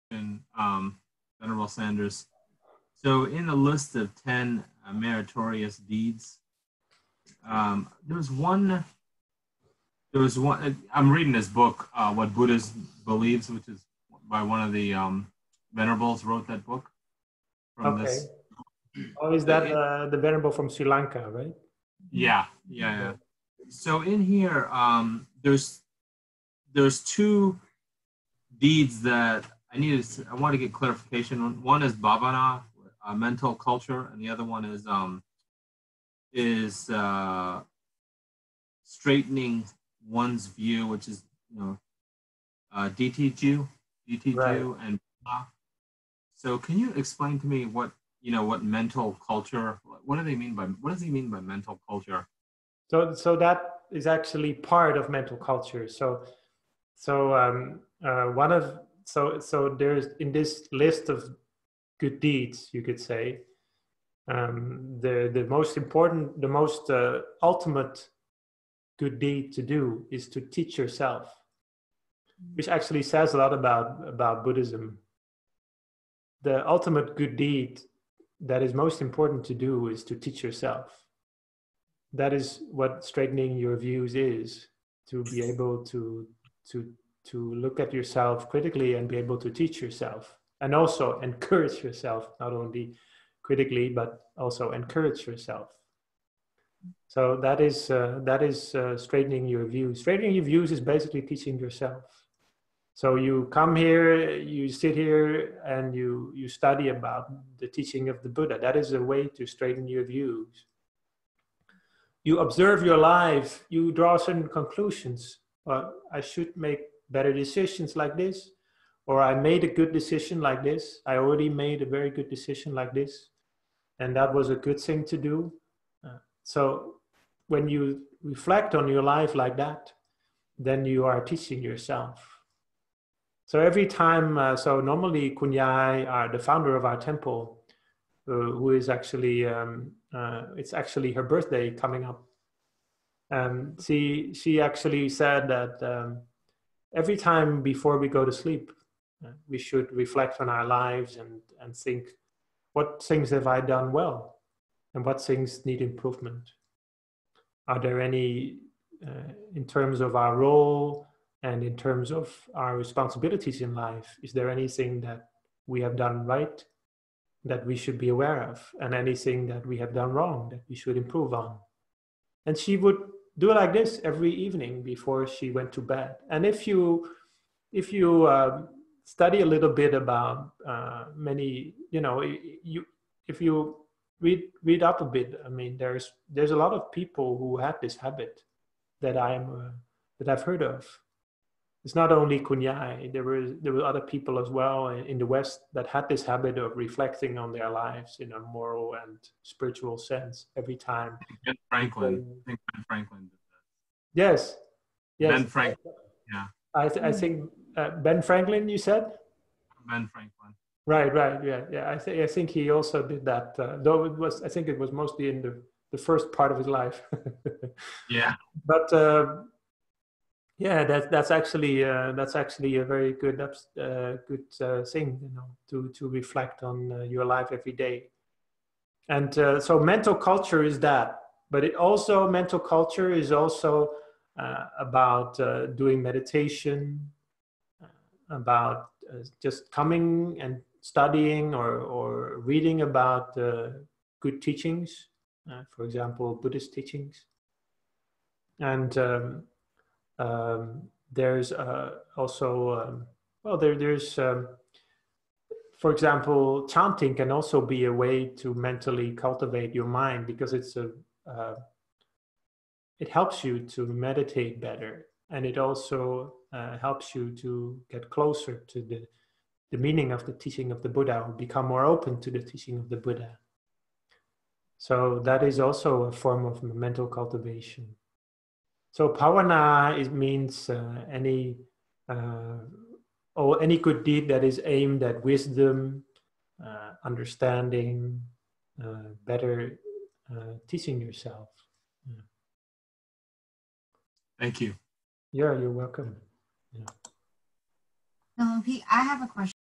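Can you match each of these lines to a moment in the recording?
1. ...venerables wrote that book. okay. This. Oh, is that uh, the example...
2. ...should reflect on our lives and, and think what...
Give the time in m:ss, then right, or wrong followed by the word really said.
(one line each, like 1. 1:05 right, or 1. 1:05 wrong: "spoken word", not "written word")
1. 0:15 wrong: "venerable", not "example"
2. 2:29 right.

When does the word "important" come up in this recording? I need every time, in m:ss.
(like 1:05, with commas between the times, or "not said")
1:05, 1:19.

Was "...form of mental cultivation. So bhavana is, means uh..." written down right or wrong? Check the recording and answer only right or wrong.
right.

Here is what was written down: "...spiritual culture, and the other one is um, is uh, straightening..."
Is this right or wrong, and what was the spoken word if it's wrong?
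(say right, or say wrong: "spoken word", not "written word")
wrong: "mental", not "spiritual".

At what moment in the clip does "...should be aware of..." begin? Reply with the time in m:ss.
2:47.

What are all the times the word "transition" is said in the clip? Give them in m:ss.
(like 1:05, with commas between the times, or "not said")
not said.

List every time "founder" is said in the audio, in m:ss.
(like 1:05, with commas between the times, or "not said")
2:16.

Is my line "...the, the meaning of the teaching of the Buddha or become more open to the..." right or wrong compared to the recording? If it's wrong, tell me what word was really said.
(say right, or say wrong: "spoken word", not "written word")
right.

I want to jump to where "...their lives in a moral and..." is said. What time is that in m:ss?
3:17.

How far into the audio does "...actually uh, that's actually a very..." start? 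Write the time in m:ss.
3:41.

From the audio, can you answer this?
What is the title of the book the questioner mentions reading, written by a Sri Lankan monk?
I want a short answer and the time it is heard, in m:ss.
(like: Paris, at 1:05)
What Buddhism Believes, at 0:12.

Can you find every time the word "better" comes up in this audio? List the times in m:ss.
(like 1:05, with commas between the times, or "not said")
1:57, 4:24, 4:49.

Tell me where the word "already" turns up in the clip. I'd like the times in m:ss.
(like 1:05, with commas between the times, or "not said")
2:01.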